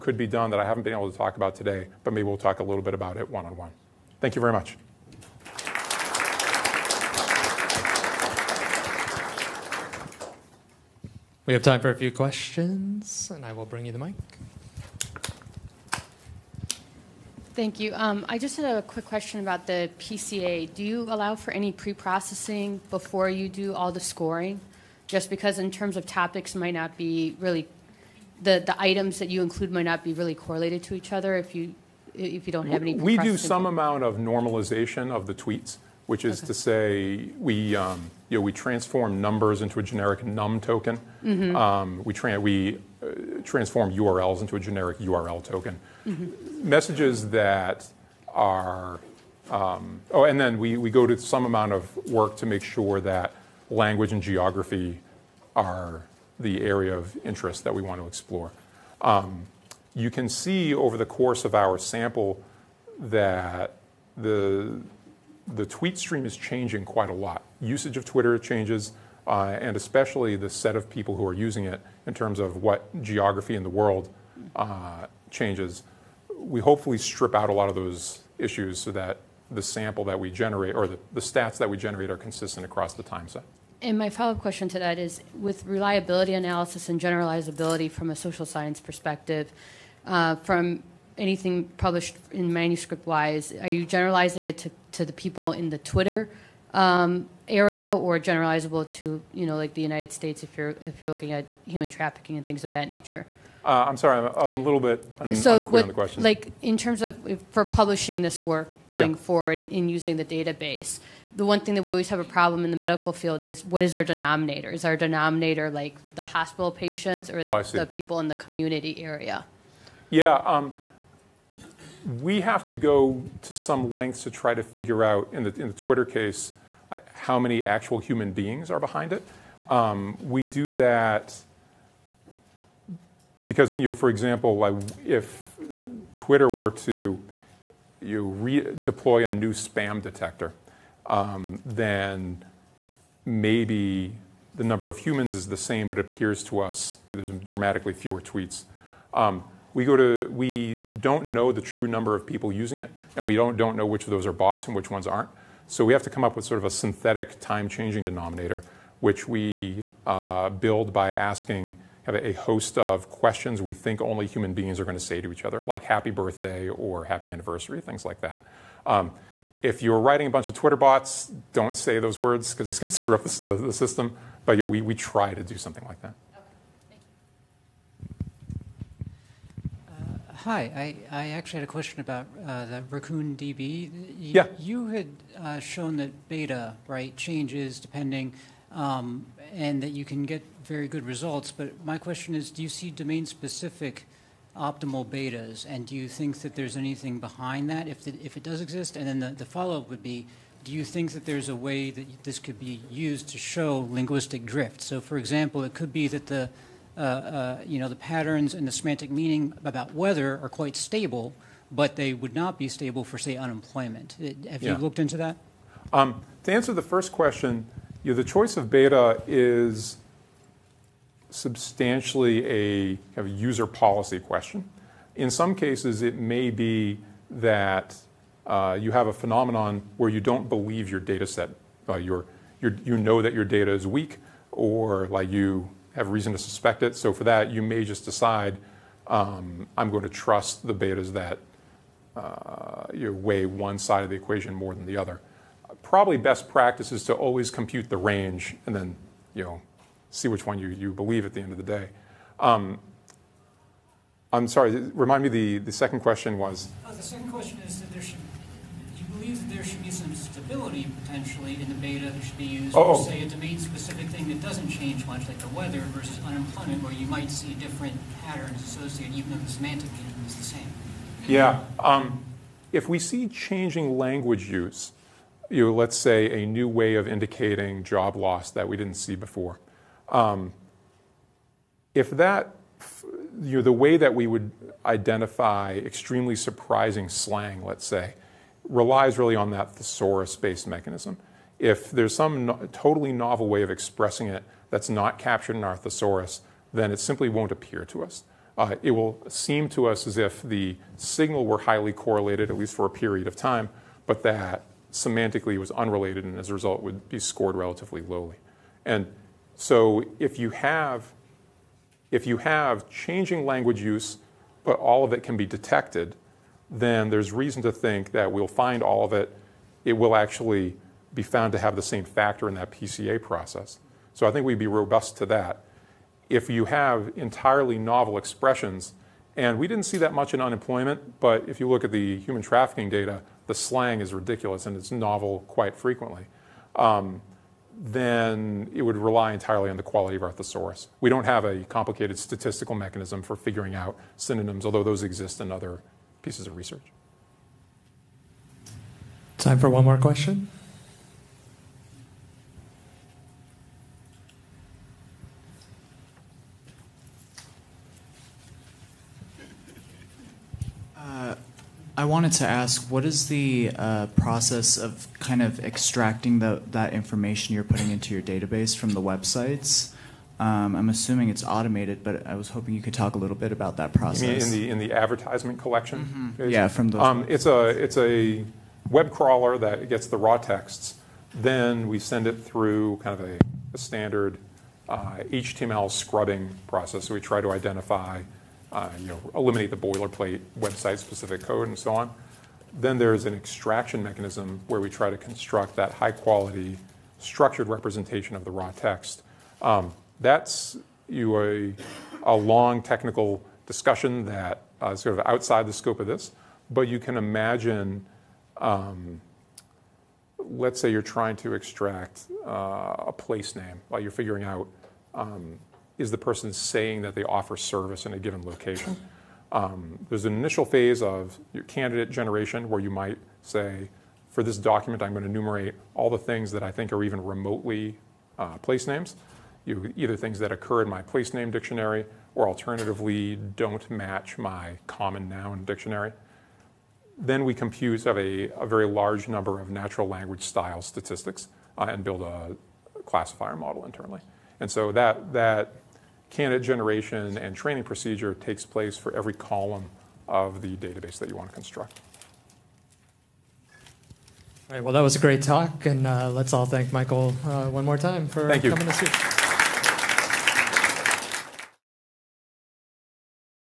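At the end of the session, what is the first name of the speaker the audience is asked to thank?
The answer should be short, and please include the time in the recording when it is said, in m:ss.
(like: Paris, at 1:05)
Michael, at 7:36.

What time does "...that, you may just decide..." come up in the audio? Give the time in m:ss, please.
3:57.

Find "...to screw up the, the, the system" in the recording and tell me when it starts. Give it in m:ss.
2:52.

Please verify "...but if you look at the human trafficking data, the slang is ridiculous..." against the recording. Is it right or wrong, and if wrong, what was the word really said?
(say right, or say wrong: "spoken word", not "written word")
right.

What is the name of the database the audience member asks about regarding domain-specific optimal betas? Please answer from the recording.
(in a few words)
Raccoon DB.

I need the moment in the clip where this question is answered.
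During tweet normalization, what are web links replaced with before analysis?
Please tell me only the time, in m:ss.
0:44.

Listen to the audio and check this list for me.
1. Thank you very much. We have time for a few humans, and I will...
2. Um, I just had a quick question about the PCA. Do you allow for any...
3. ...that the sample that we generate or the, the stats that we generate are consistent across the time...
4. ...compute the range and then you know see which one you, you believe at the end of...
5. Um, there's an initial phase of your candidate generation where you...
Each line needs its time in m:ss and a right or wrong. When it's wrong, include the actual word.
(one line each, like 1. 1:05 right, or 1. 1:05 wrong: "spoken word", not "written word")
1. 0:04 wrong: "questions", not "humans"
2. 0:17 right
3. 1:18 right
4. 4:07 right
5. 6:59 right.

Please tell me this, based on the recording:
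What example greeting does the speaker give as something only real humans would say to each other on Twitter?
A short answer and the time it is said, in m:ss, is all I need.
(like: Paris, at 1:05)
happy birthday, at 2:45.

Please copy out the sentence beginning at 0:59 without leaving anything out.
Um, you can see over the course of our sample that the, the tweet stream is changing quite a lot.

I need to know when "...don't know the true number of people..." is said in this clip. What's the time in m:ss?
2:30.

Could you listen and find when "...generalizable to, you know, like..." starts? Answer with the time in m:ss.
1:38.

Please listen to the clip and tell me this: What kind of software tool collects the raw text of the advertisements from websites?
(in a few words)
web crawler.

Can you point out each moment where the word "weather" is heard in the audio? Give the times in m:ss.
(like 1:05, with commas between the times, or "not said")
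3:29, 4:25.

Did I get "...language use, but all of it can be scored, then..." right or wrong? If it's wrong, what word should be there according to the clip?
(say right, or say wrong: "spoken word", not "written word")
wrong: "detected", not "scored".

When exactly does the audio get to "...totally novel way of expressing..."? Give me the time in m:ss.
4:52.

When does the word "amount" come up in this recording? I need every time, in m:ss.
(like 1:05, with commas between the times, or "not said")
0:33, 0:51.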